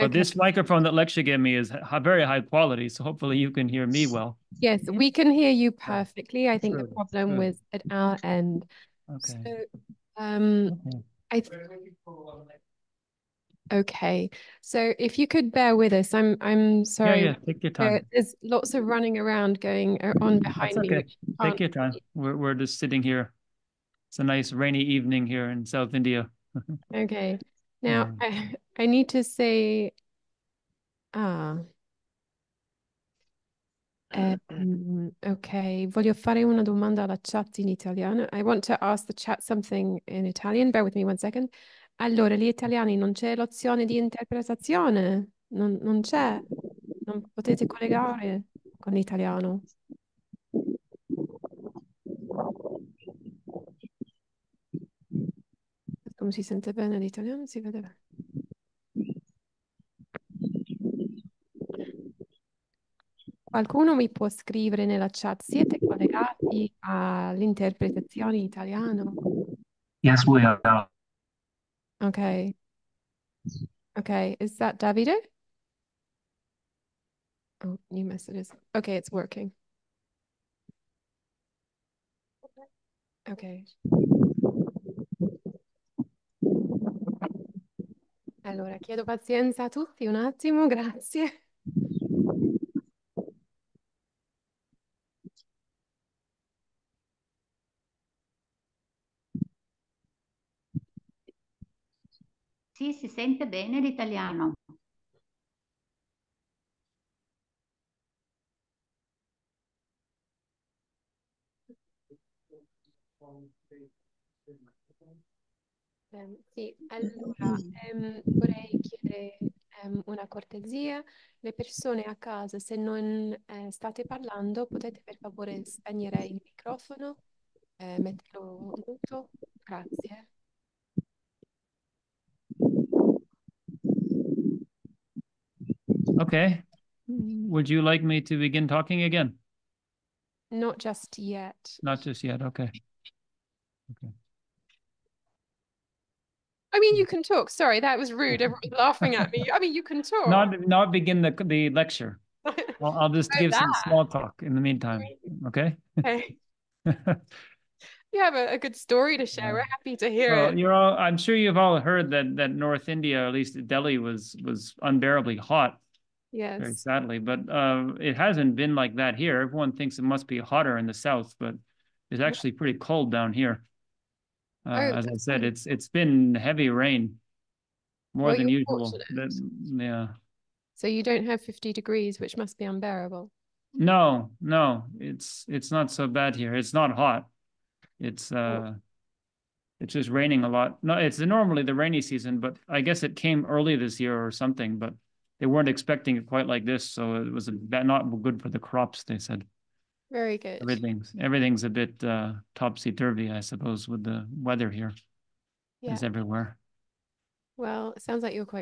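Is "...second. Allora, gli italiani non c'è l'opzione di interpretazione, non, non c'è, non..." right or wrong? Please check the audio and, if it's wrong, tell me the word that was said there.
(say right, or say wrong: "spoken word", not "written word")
right.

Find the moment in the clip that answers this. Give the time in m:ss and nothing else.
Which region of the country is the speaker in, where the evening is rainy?
0:25.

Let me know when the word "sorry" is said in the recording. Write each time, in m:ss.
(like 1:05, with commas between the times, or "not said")
0:16, 2:27.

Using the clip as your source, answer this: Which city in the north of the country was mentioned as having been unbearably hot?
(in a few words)
Delhi.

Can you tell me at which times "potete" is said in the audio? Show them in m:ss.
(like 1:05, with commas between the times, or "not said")
0:47, 2:04.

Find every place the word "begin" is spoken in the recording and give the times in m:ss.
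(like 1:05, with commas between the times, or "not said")
2:18, 2:30.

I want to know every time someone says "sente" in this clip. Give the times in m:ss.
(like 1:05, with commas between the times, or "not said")
0:56, 1:43.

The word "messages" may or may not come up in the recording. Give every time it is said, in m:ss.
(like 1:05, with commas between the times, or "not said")
1:18.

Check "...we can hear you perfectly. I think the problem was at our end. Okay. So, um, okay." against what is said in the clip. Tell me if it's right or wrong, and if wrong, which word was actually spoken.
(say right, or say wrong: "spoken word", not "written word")
right.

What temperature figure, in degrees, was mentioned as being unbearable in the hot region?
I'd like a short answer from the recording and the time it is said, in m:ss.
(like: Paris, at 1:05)
50, at 3:01.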